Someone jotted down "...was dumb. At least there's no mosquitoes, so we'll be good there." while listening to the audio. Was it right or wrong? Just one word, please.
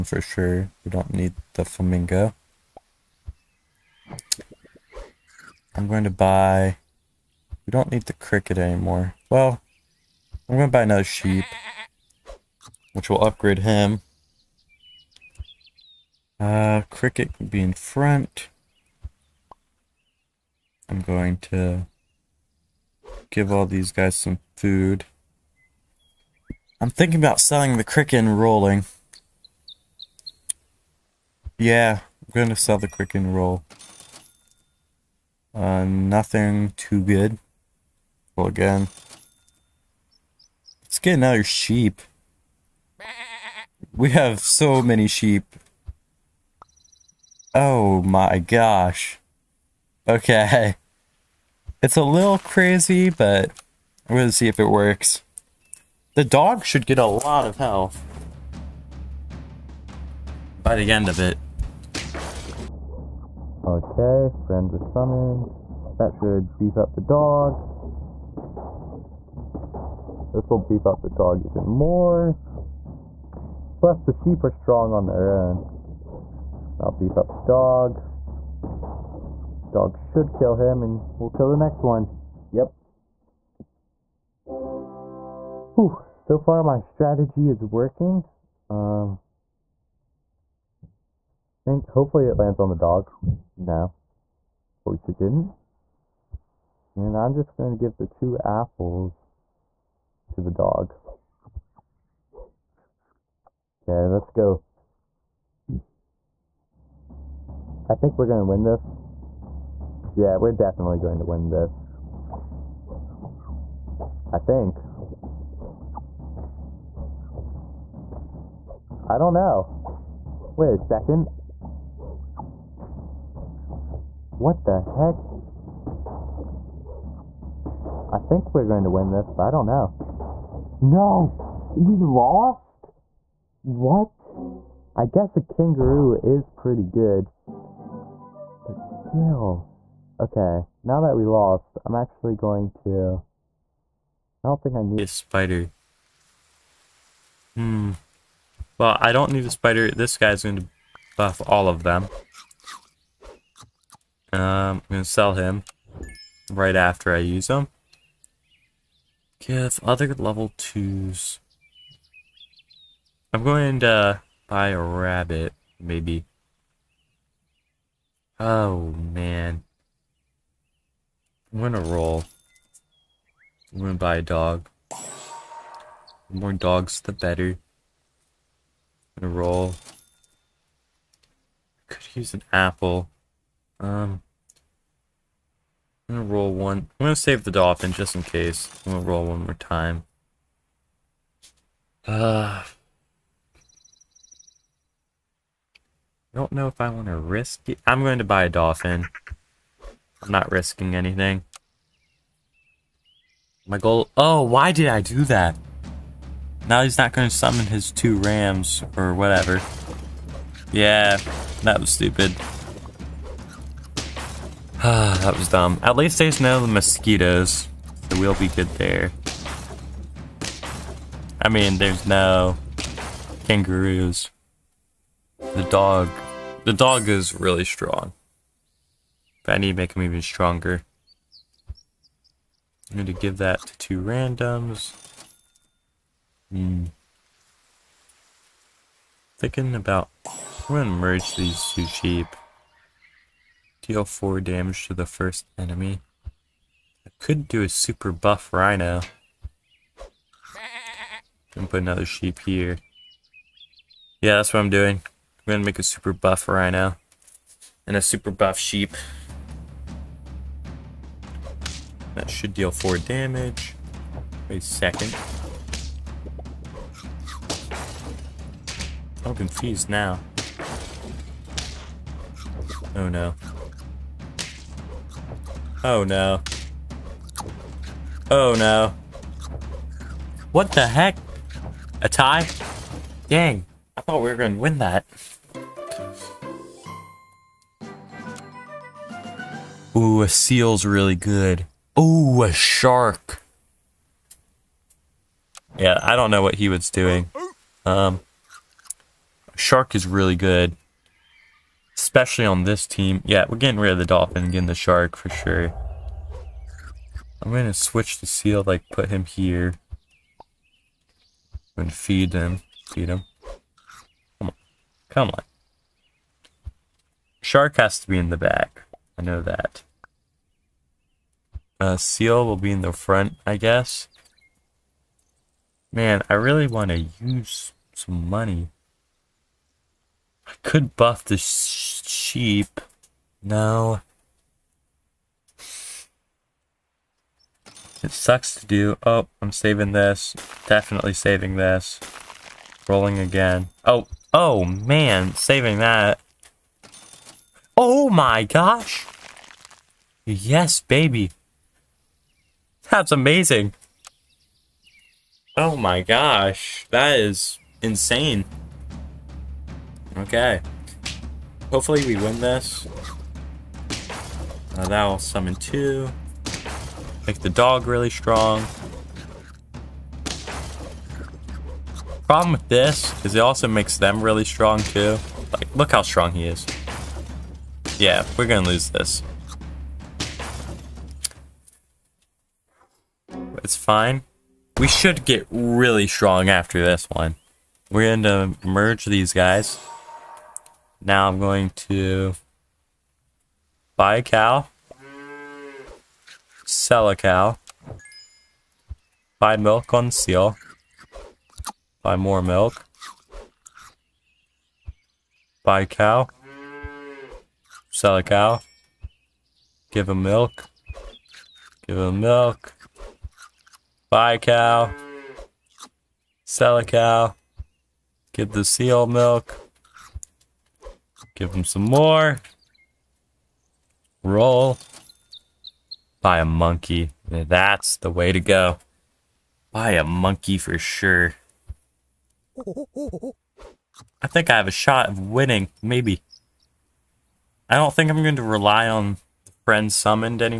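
right.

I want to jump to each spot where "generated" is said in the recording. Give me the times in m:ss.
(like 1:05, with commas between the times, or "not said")
not said.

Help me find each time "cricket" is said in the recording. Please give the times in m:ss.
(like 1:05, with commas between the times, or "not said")
0:08, 0:16.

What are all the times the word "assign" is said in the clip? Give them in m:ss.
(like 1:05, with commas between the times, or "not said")
not said.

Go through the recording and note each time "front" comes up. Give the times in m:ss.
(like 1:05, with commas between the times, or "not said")
0:17, 5:22.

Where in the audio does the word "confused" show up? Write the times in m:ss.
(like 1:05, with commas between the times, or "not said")
4:29.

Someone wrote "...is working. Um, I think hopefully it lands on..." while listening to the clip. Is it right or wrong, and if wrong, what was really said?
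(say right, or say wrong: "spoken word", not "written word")
right.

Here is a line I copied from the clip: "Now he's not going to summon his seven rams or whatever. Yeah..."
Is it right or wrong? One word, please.
wrong.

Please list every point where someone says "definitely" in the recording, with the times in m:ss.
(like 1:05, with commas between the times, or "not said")
1:50, 5:40.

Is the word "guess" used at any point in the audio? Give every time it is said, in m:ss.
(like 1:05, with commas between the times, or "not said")
2:15, 5:23.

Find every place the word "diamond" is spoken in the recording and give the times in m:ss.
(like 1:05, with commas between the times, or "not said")
not said.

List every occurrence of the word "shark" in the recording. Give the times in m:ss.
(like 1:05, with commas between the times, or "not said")
4:52, 4:59, 5:04, 5:17.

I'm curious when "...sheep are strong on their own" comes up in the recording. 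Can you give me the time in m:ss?
1:14.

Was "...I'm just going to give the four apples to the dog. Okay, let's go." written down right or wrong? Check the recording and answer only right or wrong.
wrong.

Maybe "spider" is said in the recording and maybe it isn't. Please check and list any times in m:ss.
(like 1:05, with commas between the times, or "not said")
2:25, 2:29.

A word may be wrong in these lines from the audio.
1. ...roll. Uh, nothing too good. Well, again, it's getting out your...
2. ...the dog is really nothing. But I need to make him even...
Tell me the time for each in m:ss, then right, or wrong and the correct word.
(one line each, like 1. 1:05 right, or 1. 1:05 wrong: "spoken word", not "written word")
1. 0:33 right
2. 3:46 wrong: "strong", not "nothing".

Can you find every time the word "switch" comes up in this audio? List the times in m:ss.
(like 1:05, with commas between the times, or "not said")
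5:07.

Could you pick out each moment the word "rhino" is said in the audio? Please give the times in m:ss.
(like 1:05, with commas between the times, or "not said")
4:08, 4:16.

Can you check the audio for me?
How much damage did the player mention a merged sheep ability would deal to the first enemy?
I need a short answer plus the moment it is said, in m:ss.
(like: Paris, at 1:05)
4, at 4:03.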